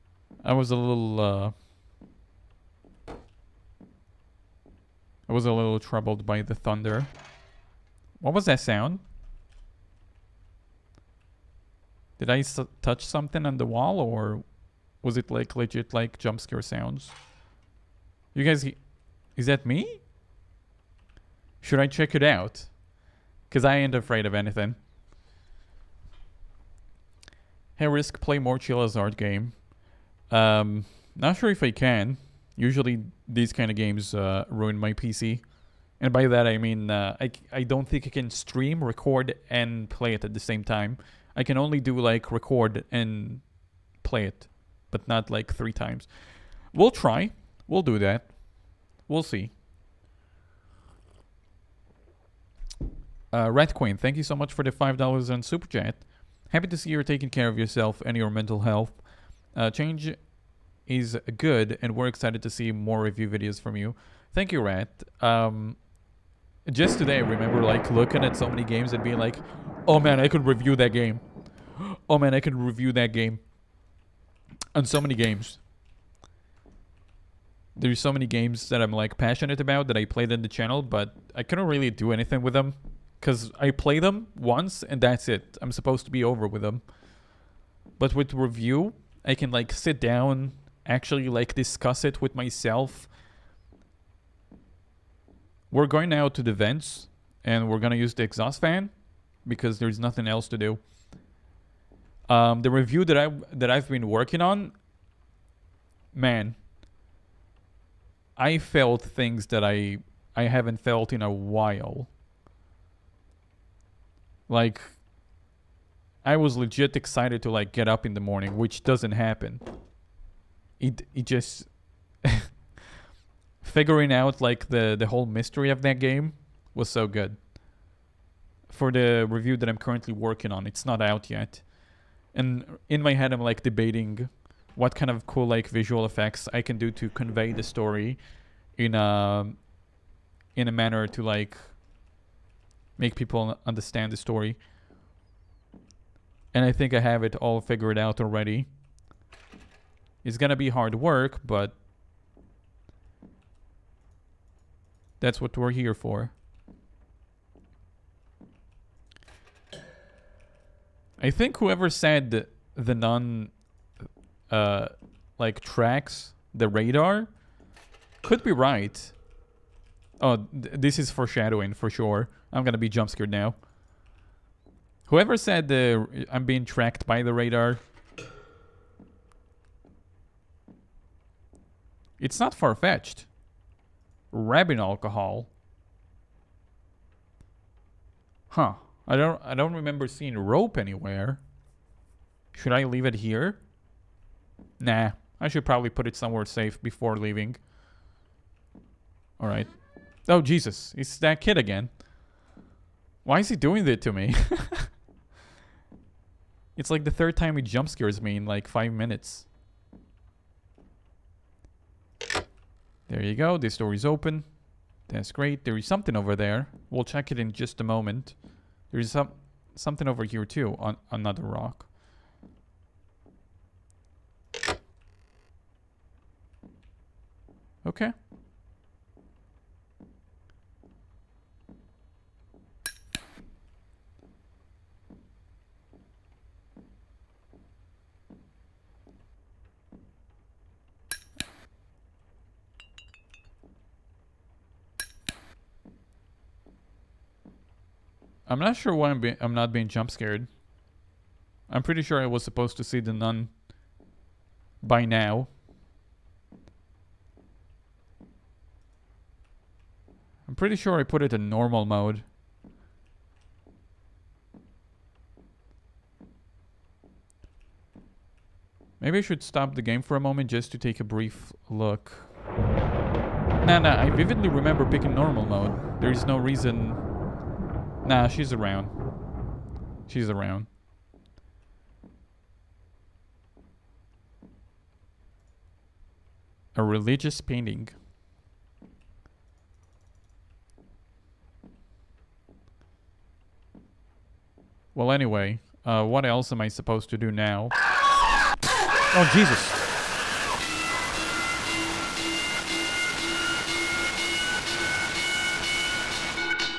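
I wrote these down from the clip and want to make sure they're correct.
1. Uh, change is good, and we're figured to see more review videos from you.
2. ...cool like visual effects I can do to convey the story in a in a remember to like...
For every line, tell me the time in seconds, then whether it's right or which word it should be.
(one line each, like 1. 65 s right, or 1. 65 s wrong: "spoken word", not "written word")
1. 59 s wrong: "excited", not "figured"
2. 135 s wrong: "manner", not "remember".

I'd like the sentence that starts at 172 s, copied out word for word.
I'm gonna be jump scared now.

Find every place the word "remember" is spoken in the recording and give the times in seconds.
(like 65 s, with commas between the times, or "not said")
67 s, 189 s, 274 s.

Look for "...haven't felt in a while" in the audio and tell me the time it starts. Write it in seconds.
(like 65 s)
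110 s.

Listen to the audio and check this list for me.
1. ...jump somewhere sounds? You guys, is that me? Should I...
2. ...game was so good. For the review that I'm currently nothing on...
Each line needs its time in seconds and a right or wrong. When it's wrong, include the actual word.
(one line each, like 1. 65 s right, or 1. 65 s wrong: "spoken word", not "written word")
1. 16 s wrong: "scare", not "somewhere"
2. 125 s wrong: "working", not "nothing".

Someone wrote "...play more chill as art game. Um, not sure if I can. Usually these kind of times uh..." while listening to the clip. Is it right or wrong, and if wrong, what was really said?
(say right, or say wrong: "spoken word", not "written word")
wrong: "games", not "times".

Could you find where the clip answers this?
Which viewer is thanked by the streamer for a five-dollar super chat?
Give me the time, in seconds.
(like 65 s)
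53 s.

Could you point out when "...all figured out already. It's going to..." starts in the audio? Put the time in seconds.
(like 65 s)
147 s.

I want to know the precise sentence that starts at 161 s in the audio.
I think whoever said the nun uh, like tracks the radar could be right.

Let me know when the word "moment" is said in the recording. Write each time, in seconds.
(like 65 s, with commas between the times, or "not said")
217 s, 270 s.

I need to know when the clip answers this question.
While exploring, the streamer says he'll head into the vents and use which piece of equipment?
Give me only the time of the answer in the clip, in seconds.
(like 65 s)
98 s.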